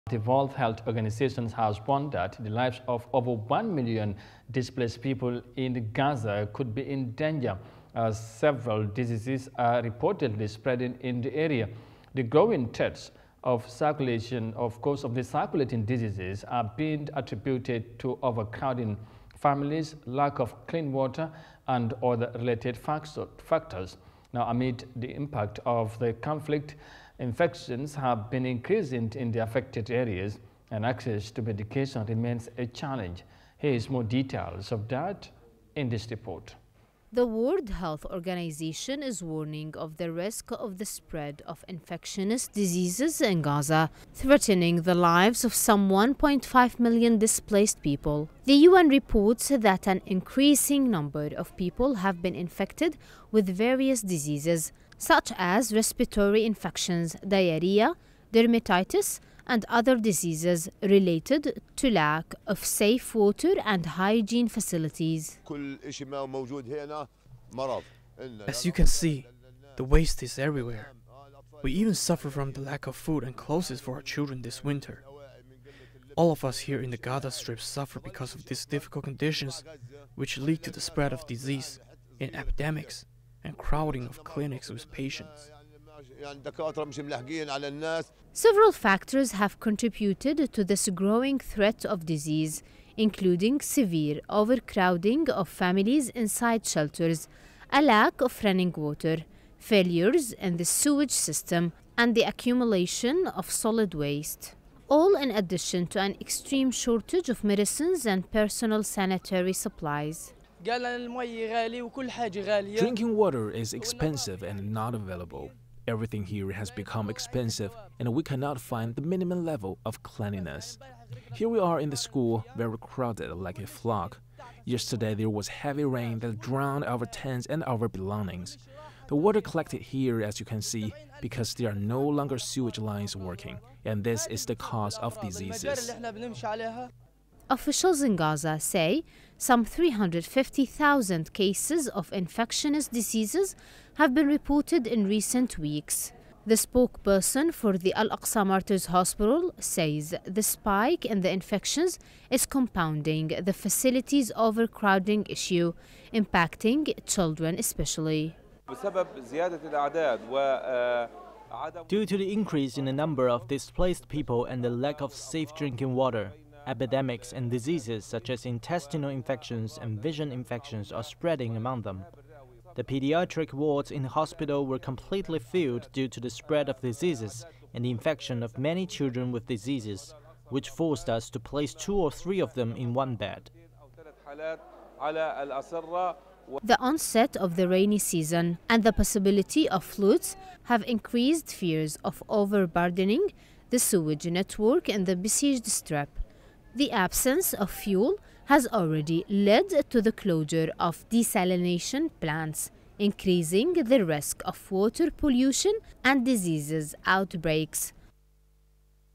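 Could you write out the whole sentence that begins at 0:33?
Here is more details of that in this report.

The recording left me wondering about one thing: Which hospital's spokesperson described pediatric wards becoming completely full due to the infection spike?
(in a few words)
Al Aqsa Martyrs Hospital.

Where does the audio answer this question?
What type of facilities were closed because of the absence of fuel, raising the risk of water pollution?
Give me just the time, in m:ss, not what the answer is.
3:21.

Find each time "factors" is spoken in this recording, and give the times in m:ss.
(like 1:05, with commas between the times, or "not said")
0:22, 1:28.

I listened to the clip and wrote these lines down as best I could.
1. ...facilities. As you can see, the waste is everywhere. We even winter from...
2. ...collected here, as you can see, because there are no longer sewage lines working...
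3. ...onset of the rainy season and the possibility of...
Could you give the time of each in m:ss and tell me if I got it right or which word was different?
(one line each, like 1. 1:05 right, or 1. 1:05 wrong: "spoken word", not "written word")
1. 1:04 wrong: "suffer", not "winter"
2. 2:09 right
3. 3:06 right.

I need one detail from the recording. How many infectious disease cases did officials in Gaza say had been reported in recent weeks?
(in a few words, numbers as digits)
350,000.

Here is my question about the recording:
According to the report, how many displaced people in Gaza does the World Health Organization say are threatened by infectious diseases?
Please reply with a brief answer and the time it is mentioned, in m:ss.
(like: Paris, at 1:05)
1.5 million, at 0:45.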